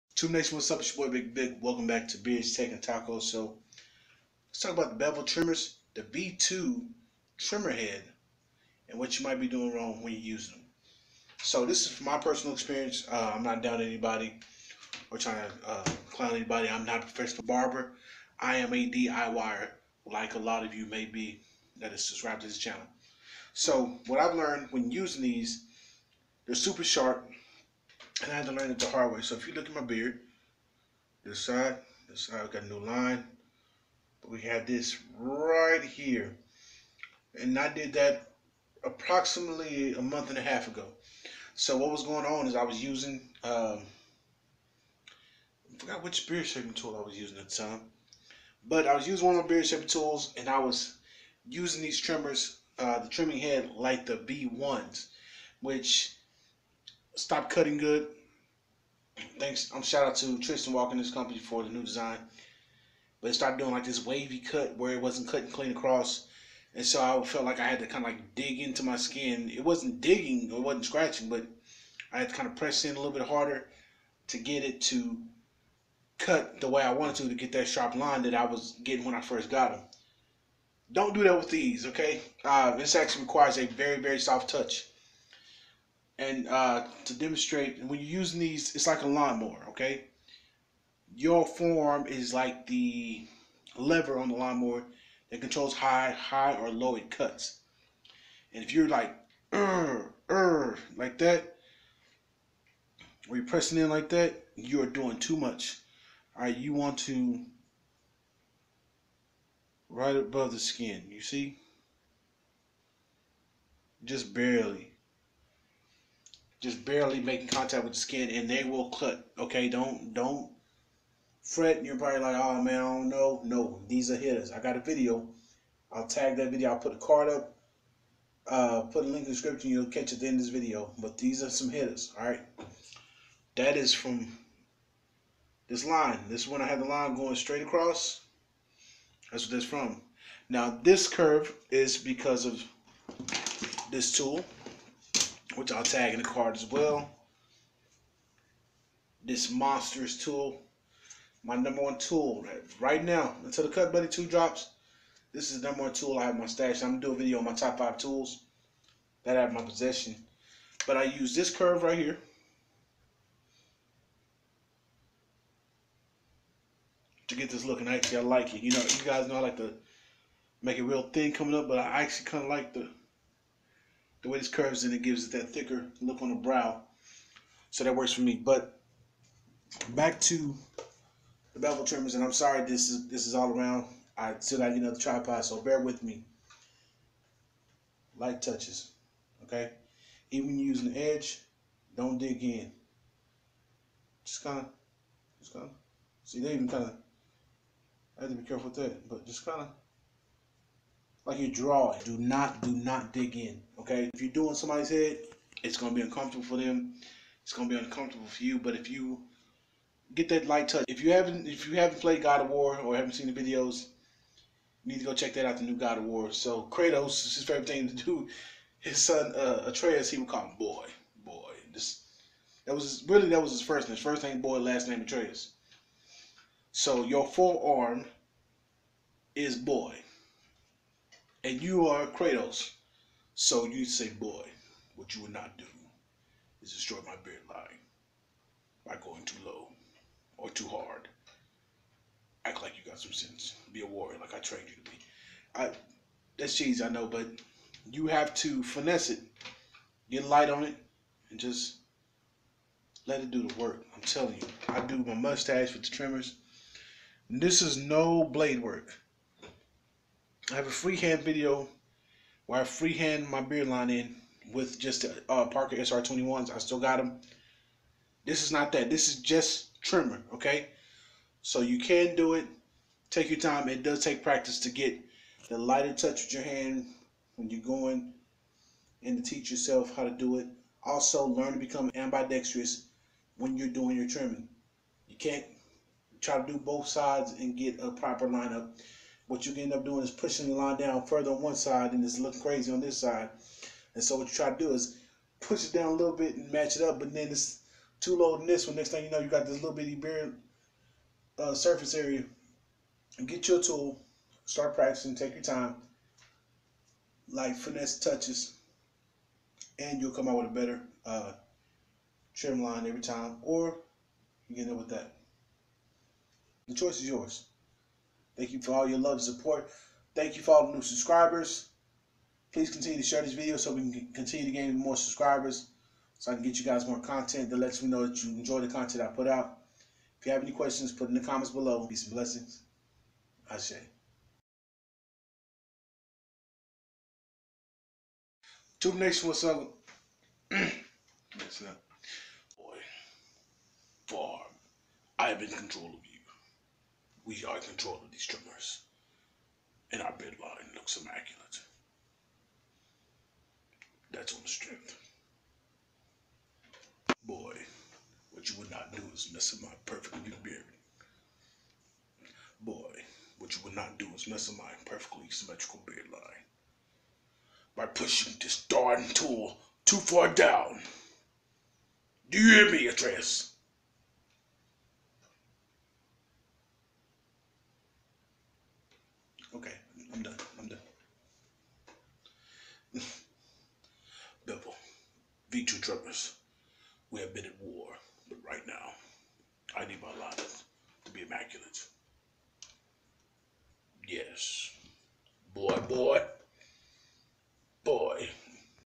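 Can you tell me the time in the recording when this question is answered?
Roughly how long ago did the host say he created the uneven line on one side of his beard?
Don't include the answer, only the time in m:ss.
0:39.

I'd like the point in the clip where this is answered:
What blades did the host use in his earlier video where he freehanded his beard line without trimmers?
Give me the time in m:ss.
4:25.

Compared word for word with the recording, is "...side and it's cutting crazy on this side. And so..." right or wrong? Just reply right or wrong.
wrong.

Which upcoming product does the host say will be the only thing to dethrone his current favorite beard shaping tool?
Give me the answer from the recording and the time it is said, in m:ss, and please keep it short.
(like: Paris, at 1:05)
Cut Buddy 2, at 2:33.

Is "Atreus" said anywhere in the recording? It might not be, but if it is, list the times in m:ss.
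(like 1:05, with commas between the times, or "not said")
3:39, 3:45, 6:12.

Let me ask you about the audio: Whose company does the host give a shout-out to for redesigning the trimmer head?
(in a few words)
Tristan Walker.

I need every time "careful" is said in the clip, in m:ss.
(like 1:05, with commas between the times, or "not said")
3:18.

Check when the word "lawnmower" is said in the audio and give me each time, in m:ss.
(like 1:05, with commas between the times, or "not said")
1:29, 1:34.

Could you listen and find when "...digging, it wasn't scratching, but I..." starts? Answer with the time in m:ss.
1:10.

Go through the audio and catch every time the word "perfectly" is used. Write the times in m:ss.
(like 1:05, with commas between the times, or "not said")
5:59, 6:04.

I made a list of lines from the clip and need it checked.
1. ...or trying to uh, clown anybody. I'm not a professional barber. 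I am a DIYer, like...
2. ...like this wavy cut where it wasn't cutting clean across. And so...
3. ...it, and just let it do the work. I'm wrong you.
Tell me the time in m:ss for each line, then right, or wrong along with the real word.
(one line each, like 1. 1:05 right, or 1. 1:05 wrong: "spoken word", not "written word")
1. 0:15 right
2. 1:03 right
3. 4:10 wrong: "telling", not "wrong".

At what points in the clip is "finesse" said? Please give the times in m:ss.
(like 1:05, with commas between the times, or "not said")
4:08, 5:07.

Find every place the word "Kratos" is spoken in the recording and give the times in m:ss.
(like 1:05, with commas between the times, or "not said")
3:36, 3:52.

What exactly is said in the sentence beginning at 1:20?
Don't do that with these, okay?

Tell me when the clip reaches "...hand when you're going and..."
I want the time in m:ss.
4:36.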